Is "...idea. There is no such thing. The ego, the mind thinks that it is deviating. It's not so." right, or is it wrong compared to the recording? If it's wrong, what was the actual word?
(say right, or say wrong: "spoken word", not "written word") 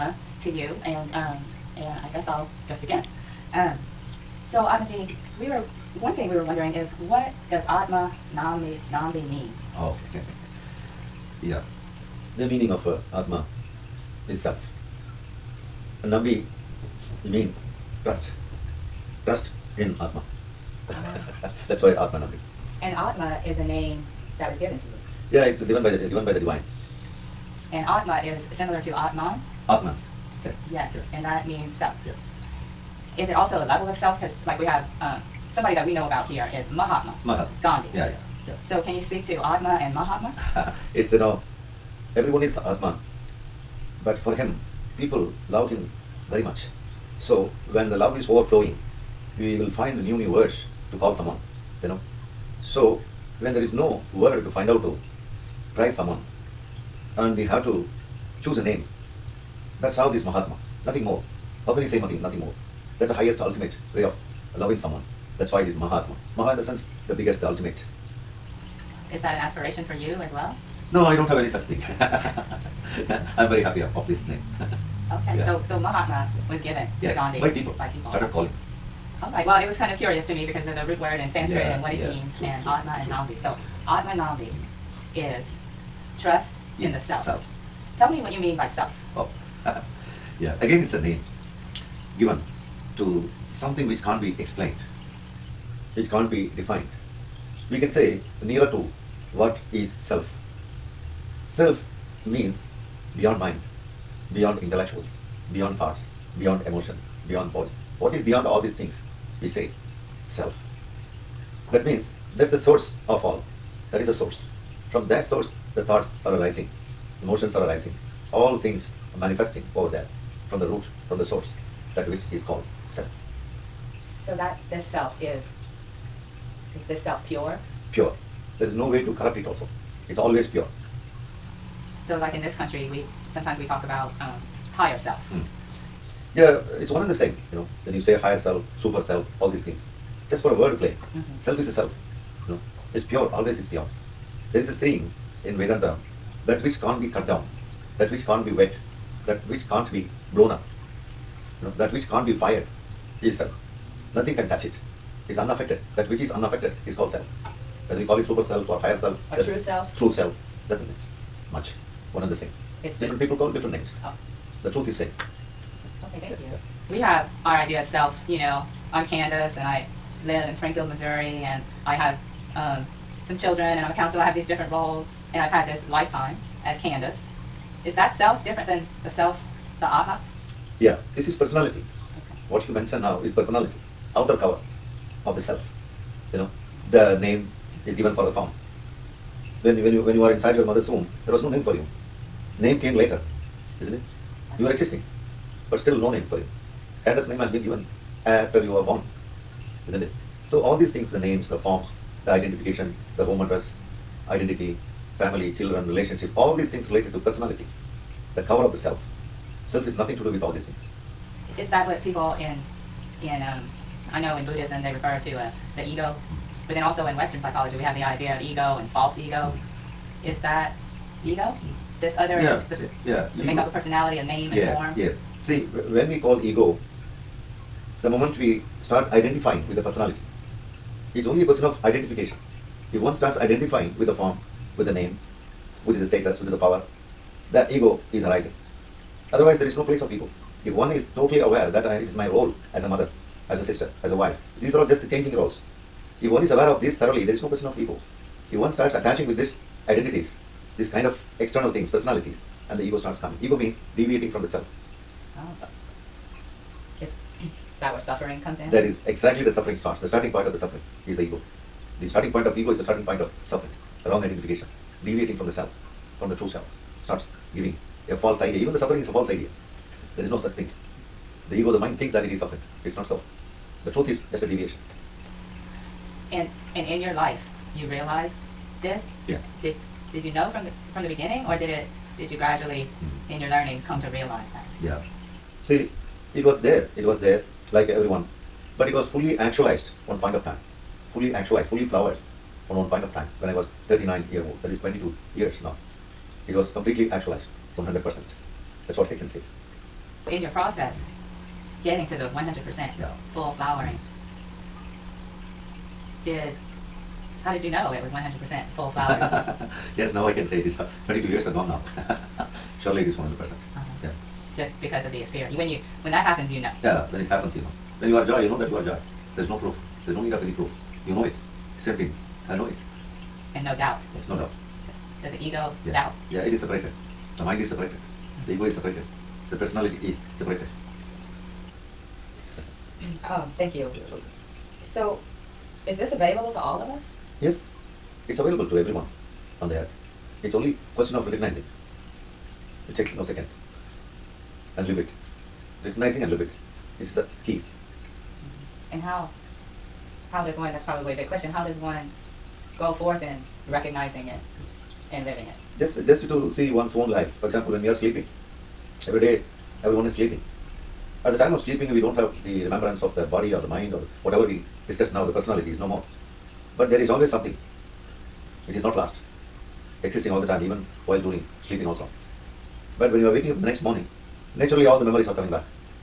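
wrong: "suffering", not "deviating".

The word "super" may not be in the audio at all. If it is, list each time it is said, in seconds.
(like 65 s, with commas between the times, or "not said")
138 s, 158 s.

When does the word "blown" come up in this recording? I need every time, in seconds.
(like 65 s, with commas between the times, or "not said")
150 s.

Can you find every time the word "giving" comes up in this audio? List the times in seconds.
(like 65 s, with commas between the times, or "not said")
267 s.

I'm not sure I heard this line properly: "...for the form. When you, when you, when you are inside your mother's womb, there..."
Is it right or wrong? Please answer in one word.
right.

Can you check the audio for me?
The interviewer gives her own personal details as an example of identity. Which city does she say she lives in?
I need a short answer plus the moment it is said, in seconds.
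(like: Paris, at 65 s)
Springfield, Missouri, at 170 s.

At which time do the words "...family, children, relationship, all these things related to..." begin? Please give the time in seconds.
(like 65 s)
205 s.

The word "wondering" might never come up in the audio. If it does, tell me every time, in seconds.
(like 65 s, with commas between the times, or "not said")
6 s.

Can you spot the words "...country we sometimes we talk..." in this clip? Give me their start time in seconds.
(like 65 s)
132 s.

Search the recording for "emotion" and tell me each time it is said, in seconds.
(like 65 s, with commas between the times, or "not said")
106 s, 117 s.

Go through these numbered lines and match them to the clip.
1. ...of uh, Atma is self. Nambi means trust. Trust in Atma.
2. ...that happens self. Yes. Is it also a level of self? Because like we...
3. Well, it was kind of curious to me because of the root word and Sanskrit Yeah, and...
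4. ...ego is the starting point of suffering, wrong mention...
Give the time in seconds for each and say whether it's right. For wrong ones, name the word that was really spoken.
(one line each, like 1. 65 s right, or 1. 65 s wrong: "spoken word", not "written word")
1. 12 s right
2. 31 s wrong: "means", not "happens"
3. 79 s right
4. 262 s wrong: "identification", not "mention".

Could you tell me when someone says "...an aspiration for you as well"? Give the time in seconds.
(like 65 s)
69 s.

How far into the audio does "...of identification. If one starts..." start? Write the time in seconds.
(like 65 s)
231 s.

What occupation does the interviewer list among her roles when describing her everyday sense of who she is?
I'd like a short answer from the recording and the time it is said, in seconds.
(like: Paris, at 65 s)
Counselor, at 173 s.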